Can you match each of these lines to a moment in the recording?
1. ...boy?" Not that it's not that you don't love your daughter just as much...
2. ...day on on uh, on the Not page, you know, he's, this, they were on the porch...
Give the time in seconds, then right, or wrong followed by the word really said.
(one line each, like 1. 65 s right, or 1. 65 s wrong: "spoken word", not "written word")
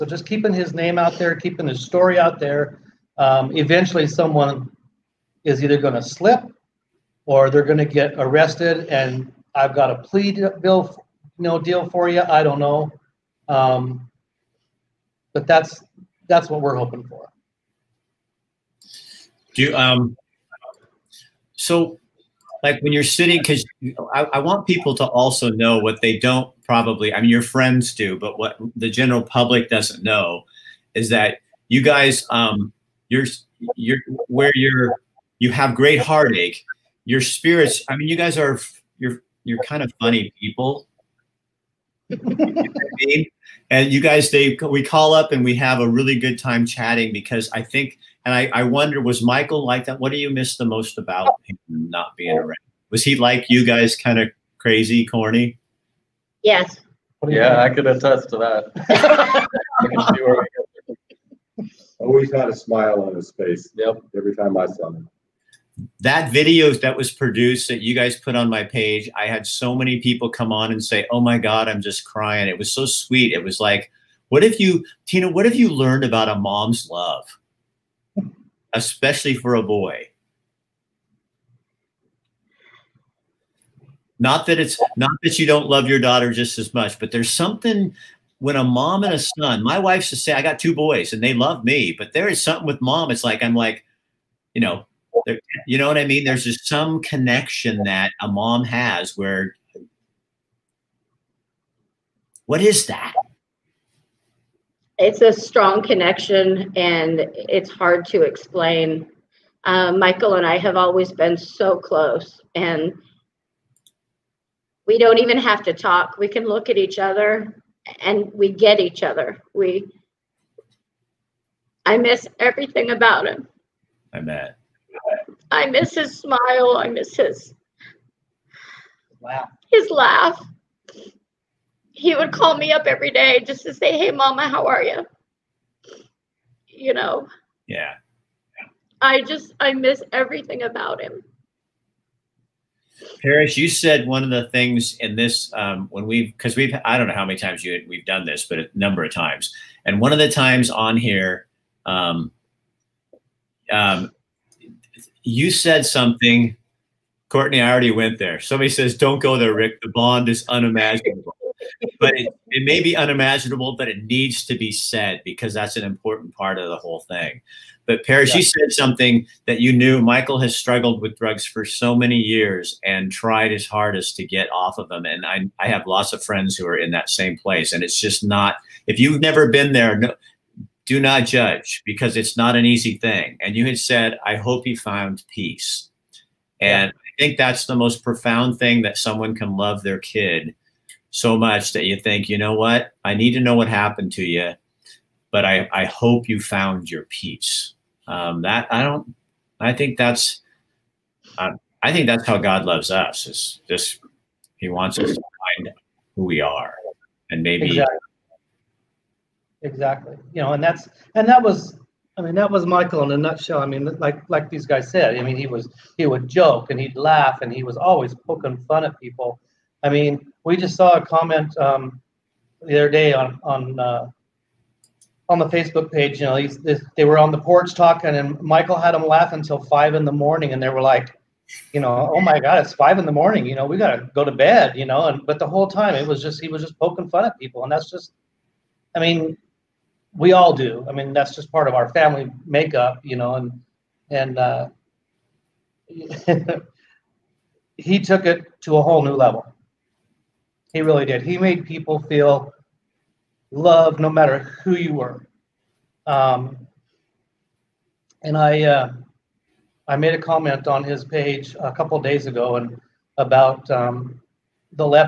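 1. 79 s right
2. 222 s wrong: "Facebook", not "Not".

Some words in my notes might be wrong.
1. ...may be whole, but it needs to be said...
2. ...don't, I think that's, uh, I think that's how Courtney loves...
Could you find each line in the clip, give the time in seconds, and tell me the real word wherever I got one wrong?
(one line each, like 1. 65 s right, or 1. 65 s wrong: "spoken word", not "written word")
1. 162 s wrong: "unimaginable", not "whole"
2. 198 s wrong: "God", not "Courtney".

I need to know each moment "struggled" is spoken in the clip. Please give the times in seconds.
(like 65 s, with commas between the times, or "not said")
170 s.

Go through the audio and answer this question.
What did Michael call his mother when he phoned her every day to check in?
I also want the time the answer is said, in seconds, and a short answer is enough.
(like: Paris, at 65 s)
Mama, at 134 s.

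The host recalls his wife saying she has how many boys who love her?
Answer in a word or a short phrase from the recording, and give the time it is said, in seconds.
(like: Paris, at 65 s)
2, at 90 s.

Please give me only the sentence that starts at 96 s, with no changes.
There's just some connection that a mom has where, what is that?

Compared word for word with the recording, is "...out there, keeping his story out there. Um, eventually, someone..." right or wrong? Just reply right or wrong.
right.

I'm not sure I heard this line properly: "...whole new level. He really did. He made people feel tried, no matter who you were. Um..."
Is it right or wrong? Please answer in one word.
wrong.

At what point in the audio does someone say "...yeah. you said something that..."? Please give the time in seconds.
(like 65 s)
168 s.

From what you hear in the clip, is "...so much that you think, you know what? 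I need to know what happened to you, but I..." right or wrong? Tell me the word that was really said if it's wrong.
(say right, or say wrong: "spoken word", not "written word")
right.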